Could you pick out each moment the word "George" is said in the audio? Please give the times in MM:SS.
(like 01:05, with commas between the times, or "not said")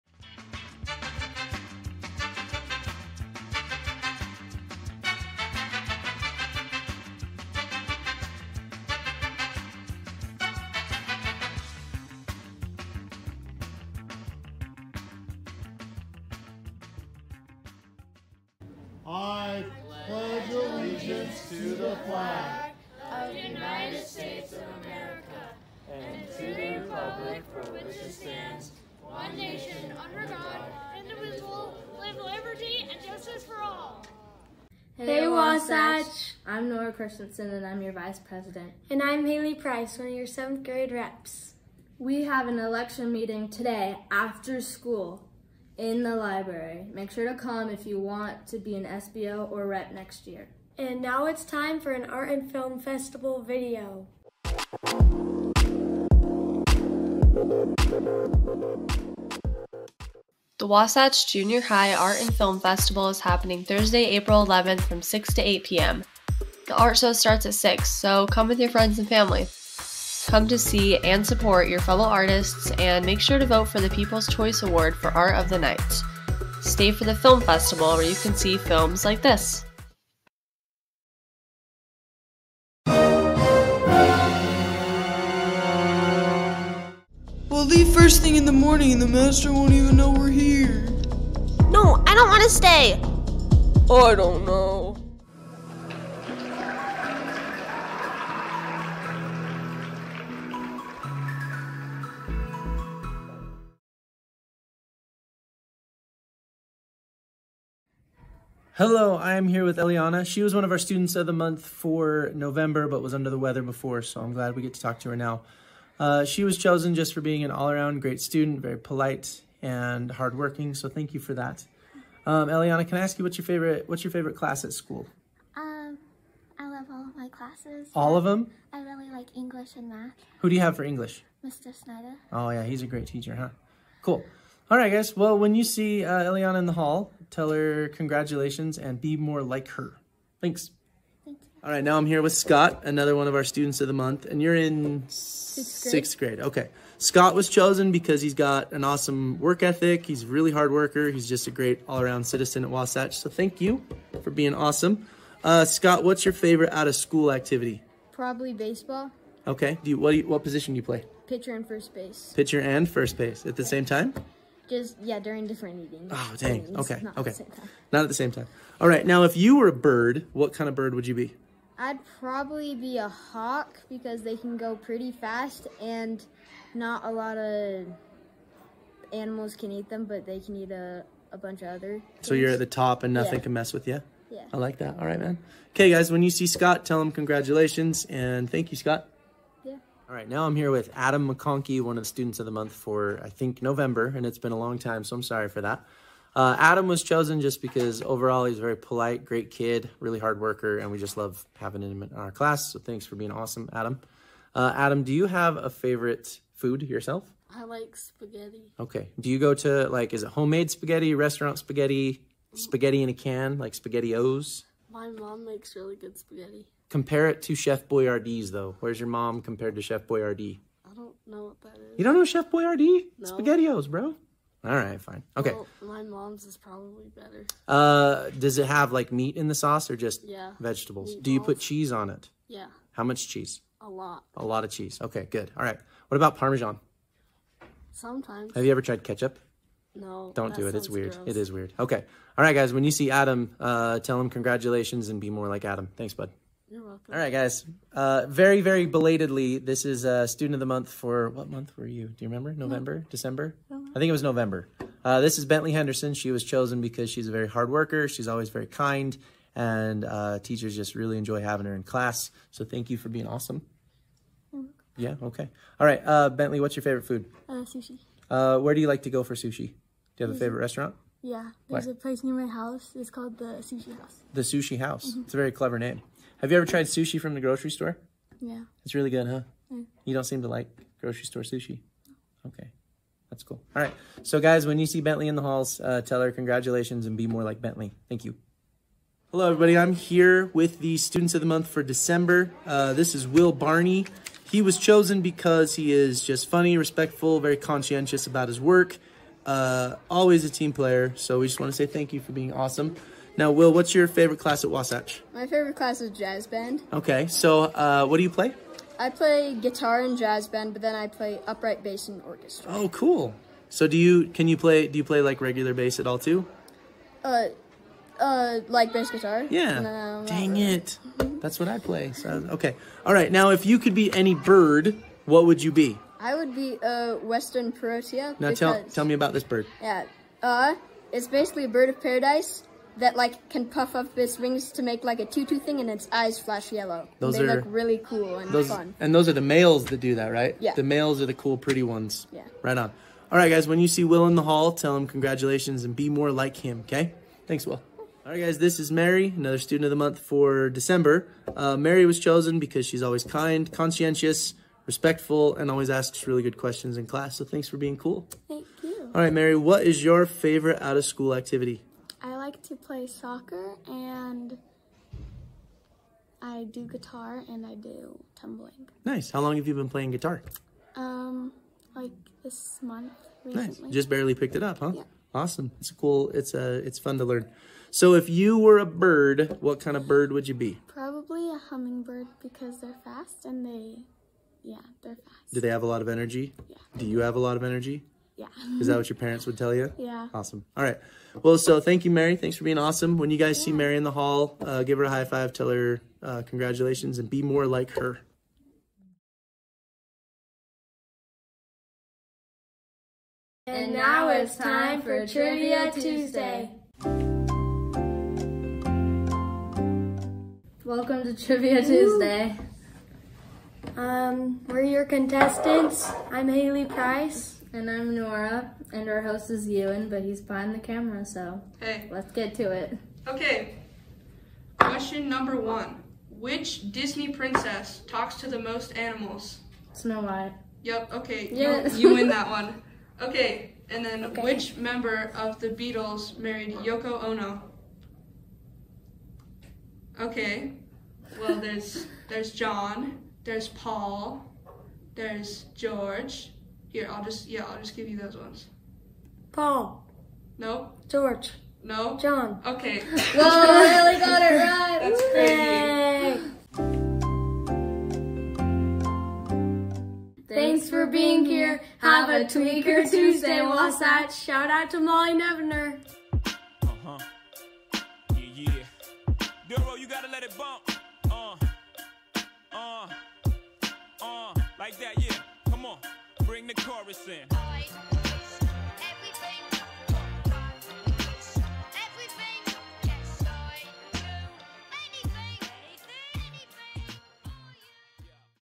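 07:25, 07:31.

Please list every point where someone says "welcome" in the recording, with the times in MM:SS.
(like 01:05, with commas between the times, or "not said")
04:06, 06:50.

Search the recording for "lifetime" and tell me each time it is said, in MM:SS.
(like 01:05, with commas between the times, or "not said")
not said.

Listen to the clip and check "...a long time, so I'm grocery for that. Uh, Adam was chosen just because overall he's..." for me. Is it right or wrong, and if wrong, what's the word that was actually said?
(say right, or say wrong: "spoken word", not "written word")
wrong: "sorry", not "grocery".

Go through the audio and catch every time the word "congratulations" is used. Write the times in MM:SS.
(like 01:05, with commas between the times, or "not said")
02:17, 03:07, 04:04, 04:46, 05:45, 06:36.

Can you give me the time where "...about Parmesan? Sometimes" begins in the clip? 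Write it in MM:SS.
03:56.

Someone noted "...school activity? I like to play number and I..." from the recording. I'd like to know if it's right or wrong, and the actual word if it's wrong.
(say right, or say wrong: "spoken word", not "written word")
wrong: "soccer", not "number".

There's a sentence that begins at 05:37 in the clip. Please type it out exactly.
Those they are, look really cool and those, fun.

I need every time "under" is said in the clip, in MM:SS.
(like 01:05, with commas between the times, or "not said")
00:30, 01:53.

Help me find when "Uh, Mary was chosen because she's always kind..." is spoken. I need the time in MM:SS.
05:51.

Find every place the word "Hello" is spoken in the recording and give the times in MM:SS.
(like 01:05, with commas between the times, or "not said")
01:48, 04:49.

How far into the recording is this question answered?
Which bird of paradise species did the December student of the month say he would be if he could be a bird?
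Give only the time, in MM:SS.
05:27.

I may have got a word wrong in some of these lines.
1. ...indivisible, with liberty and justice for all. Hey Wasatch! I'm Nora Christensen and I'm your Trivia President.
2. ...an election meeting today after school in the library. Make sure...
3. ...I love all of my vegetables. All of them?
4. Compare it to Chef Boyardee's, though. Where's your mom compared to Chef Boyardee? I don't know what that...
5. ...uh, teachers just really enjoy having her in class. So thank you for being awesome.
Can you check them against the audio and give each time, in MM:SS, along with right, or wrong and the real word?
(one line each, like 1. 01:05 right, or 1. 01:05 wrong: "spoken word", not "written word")
1. 00:30 wrong: "Vice", not "Trivia"
2. 00:42 right
3. 02:06 wrong: "classes", not "vegetables"
4. 03:36 right
5. 04:20 right.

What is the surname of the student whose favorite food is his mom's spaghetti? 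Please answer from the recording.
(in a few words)
McConkey.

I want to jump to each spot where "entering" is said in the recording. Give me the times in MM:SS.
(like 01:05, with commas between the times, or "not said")
not said.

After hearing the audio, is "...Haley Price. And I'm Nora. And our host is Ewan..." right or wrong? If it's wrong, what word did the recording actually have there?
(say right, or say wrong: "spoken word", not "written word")
right.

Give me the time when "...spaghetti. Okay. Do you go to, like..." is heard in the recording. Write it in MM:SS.
03:27.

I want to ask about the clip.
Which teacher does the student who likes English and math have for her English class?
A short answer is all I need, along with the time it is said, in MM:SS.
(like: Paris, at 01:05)
Mr. Snyder, at 02:11.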